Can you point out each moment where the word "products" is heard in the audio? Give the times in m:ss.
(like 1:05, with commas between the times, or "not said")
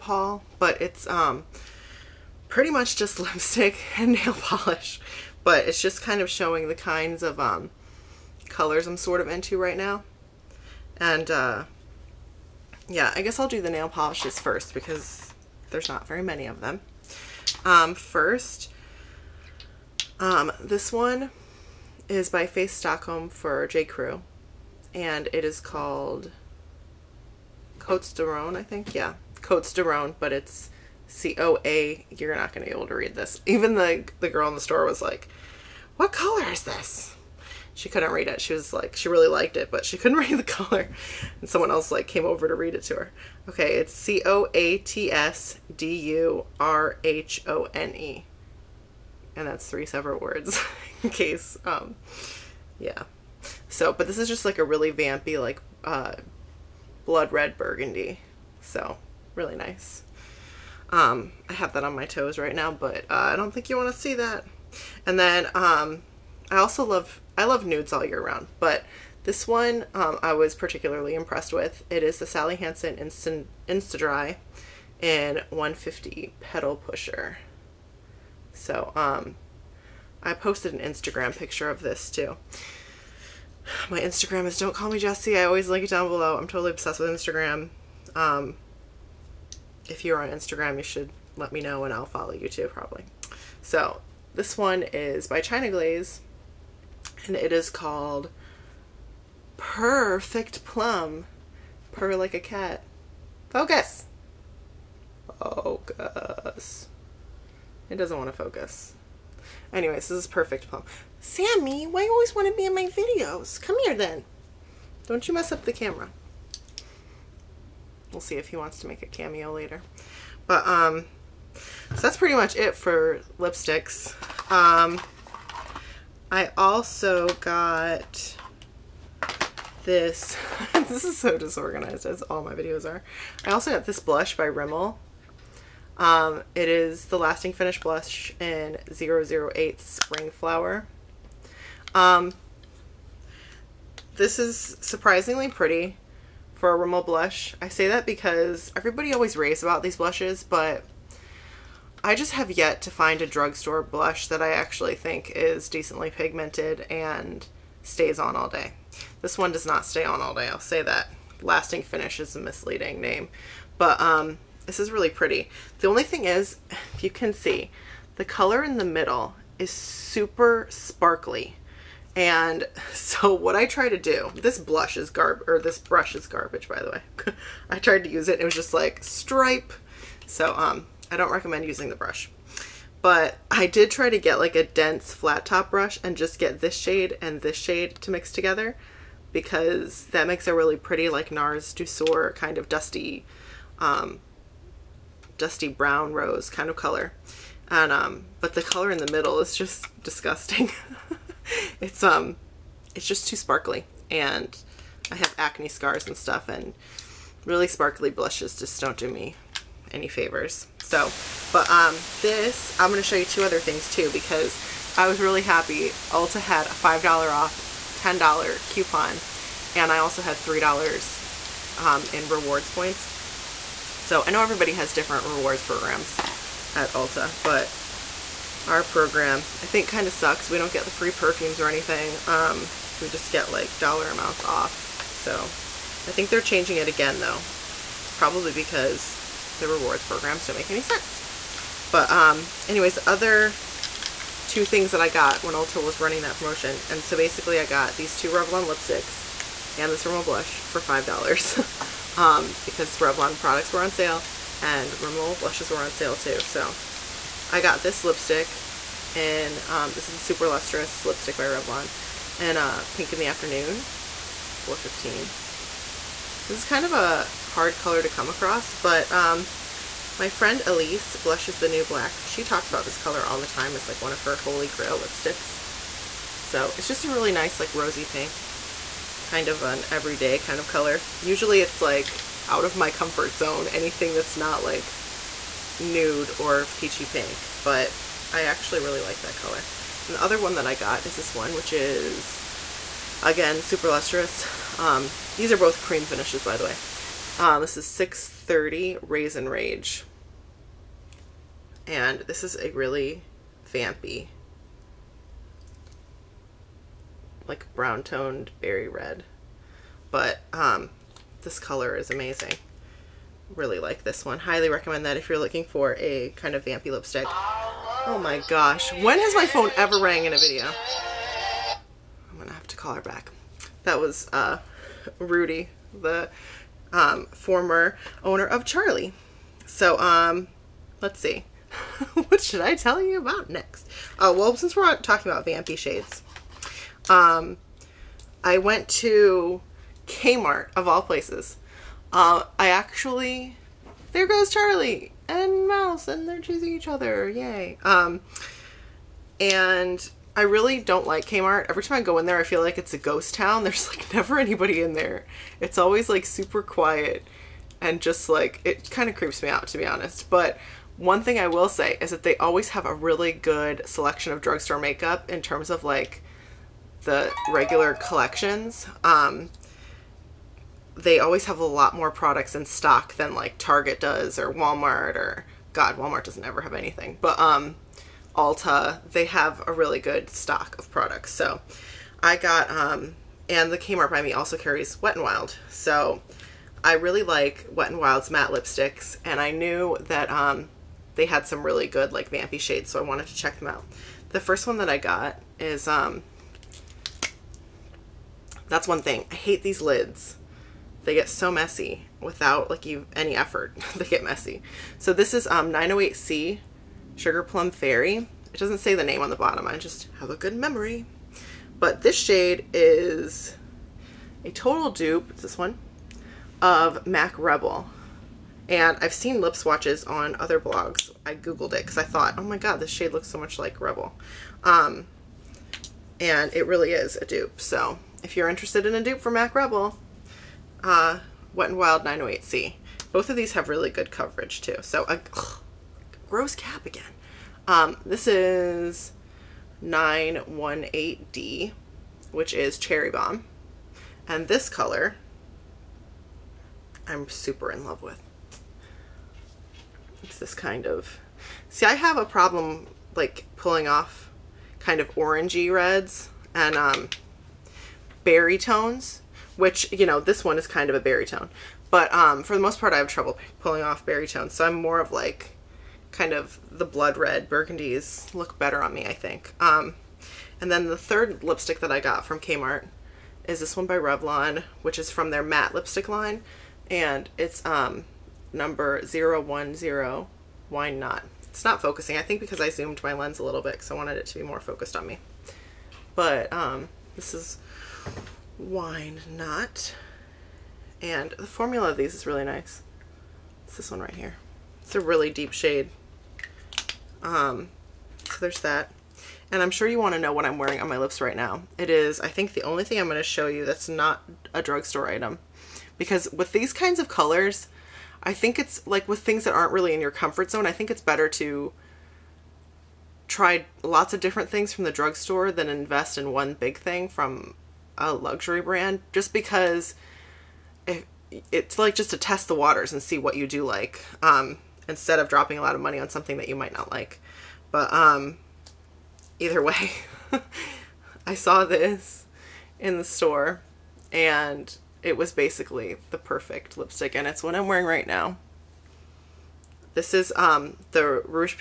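4:13, 6:12, 6:20.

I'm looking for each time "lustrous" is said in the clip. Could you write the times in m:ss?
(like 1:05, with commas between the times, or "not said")
4:20, 4:53.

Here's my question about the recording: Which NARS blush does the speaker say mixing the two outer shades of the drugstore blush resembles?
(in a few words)
Douceur.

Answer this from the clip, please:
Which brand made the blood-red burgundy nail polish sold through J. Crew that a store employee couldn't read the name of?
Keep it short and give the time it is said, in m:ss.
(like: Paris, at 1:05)
Face Stockholm, at 0:22.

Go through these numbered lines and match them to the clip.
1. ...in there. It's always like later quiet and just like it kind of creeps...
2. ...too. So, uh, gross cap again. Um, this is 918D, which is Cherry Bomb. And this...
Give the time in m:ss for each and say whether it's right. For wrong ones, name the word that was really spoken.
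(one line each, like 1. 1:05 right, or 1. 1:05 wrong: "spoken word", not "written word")
1. 5:54 wrong: "super", not "later"
2. 7:14 right.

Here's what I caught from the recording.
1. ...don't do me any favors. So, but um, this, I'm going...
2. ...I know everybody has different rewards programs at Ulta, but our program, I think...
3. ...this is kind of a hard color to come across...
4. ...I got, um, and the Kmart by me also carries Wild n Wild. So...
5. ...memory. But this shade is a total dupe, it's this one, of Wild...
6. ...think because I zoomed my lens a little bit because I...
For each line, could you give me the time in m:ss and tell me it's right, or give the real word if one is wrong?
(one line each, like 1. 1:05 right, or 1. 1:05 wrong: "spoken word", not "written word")
1. 3:28 right
2. 3:44 right
3. 4:26 right
4. 6:22 wrong: "Wet", not "Wild"
5. 6:50 wrong: "MAC", not "Wild"
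6. 8:02 right.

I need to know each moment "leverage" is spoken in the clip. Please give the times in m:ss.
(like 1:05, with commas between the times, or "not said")
not said.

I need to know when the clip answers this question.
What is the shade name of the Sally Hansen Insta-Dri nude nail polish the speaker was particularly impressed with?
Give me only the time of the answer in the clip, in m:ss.
1:16.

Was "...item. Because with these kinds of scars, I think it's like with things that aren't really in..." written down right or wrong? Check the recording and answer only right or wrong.
wrong.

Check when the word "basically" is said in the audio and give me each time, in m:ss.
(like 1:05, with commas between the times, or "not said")
4:07, 8:55.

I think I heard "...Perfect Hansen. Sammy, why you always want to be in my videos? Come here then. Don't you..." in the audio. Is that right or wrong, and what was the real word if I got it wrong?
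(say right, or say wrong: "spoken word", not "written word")
wrong: "Plum", not "Hansen".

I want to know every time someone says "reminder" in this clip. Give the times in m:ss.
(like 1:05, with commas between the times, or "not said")
not said.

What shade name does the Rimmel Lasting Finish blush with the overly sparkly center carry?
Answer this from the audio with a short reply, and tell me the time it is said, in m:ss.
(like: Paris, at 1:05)
Spring Flower, at 2:19.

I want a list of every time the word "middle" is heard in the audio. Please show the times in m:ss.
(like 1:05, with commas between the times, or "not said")
2:48, 3:19.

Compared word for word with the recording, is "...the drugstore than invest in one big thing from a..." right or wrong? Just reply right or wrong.
right.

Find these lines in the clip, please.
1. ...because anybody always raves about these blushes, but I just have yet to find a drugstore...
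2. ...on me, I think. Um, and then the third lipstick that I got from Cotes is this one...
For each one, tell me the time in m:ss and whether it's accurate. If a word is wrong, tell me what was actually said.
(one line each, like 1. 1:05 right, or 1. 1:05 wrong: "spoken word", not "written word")
1. 2:28 wrong: "everybody", not "anybody"
2. 7:48 wrong: "Kmart", not "Cotes".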